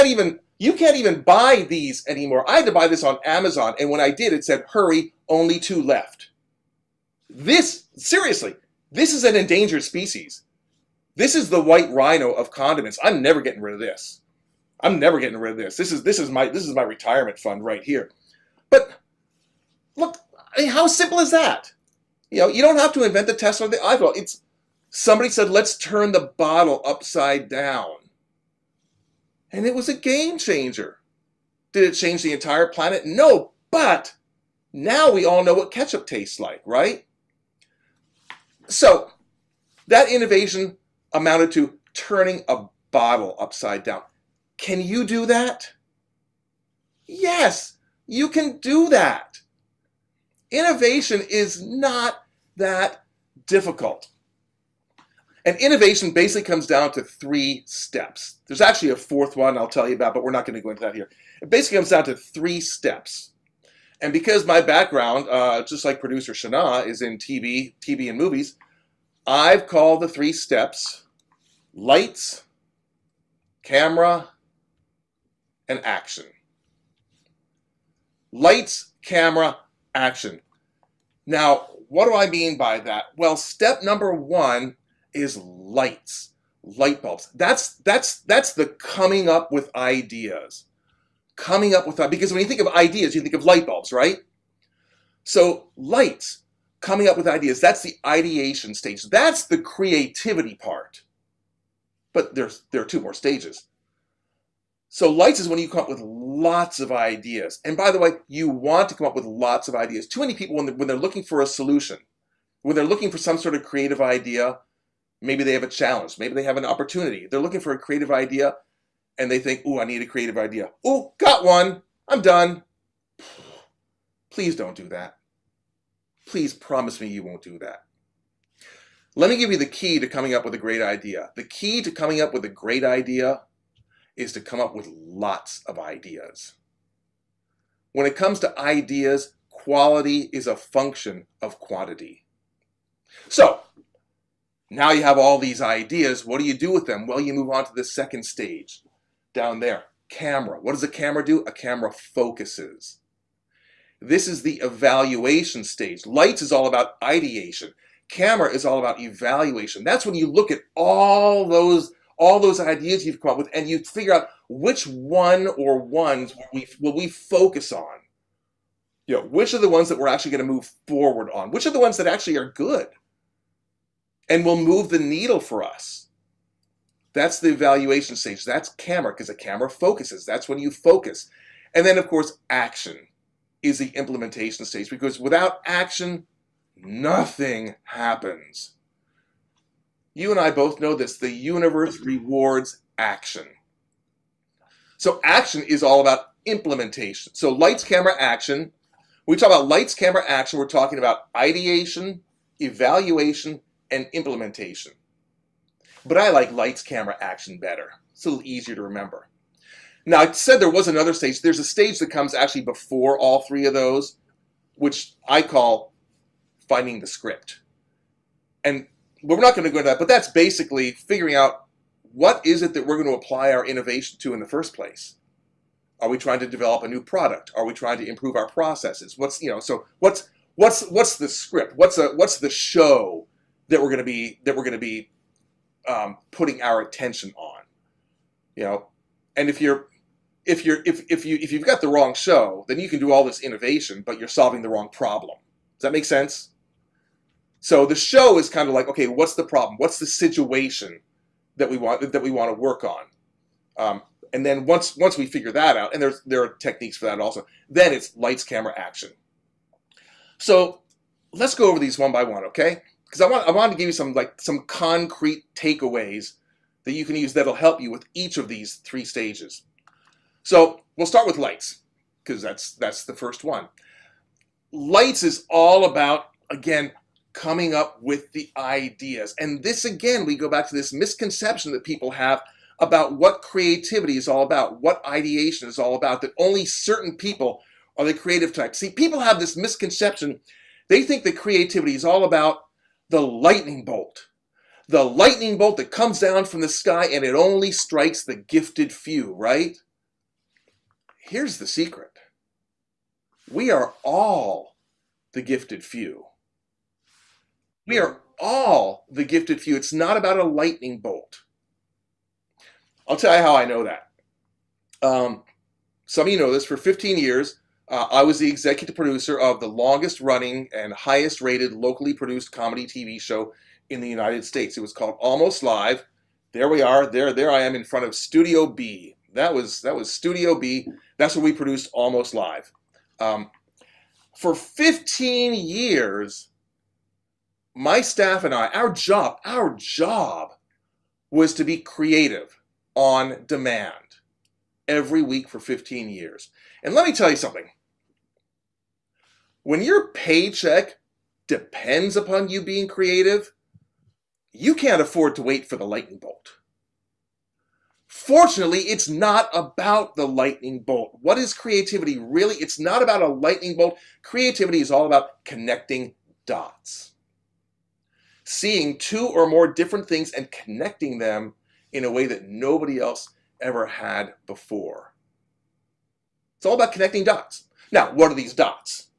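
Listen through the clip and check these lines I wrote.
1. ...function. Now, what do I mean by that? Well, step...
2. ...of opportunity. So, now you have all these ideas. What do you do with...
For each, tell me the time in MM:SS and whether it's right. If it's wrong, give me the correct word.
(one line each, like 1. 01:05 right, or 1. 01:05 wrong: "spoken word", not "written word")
1. 01:19 wrong: "action", not "function"
2. 02:21 wrong: "quantity", not "opportunity".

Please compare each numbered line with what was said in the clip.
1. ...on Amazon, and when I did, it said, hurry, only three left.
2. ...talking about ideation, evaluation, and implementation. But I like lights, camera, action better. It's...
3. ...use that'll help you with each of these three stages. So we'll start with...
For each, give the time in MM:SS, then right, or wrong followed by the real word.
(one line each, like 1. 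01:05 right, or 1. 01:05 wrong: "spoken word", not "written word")
1. 00:03 wrong: "two", not "three"
2. 03:20 right
3. 04:27 right.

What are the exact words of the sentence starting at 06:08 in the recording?
Seeing two or more different things and connecting them in a way that nobody else ever had before.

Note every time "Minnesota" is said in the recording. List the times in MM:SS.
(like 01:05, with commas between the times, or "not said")
not said.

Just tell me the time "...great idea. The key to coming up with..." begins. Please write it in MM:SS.
02:10.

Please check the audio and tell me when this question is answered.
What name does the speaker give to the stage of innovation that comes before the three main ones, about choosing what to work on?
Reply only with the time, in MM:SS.
03:36.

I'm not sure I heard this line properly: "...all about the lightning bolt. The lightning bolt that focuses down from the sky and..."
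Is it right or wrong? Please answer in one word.
wrong.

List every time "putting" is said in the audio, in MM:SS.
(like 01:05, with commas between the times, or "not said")
03:56.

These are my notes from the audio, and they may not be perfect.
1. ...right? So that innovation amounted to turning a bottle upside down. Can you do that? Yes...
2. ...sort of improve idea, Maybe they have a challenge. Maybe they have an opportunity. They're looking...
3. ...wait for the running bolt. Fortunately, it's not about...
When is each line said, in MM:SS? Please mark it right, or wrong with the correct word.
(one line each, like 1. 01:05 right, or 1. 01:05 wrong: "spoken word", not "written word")
1. 00:36 right
2. 01:53 wrong: "creative", not "improve"
3. 05:55 wrong: "lightning", not "running".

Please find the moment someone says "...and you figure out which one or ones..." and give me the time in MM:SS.
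02:43.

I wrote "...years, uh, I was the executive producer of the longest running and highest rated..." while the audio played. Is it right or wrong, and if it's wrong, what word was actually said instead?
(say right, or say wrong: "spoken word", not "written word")
right.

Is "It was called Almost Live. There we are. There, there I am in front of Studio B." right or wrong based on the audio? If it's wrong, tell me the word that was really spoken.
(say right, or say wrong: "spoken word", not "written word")
right.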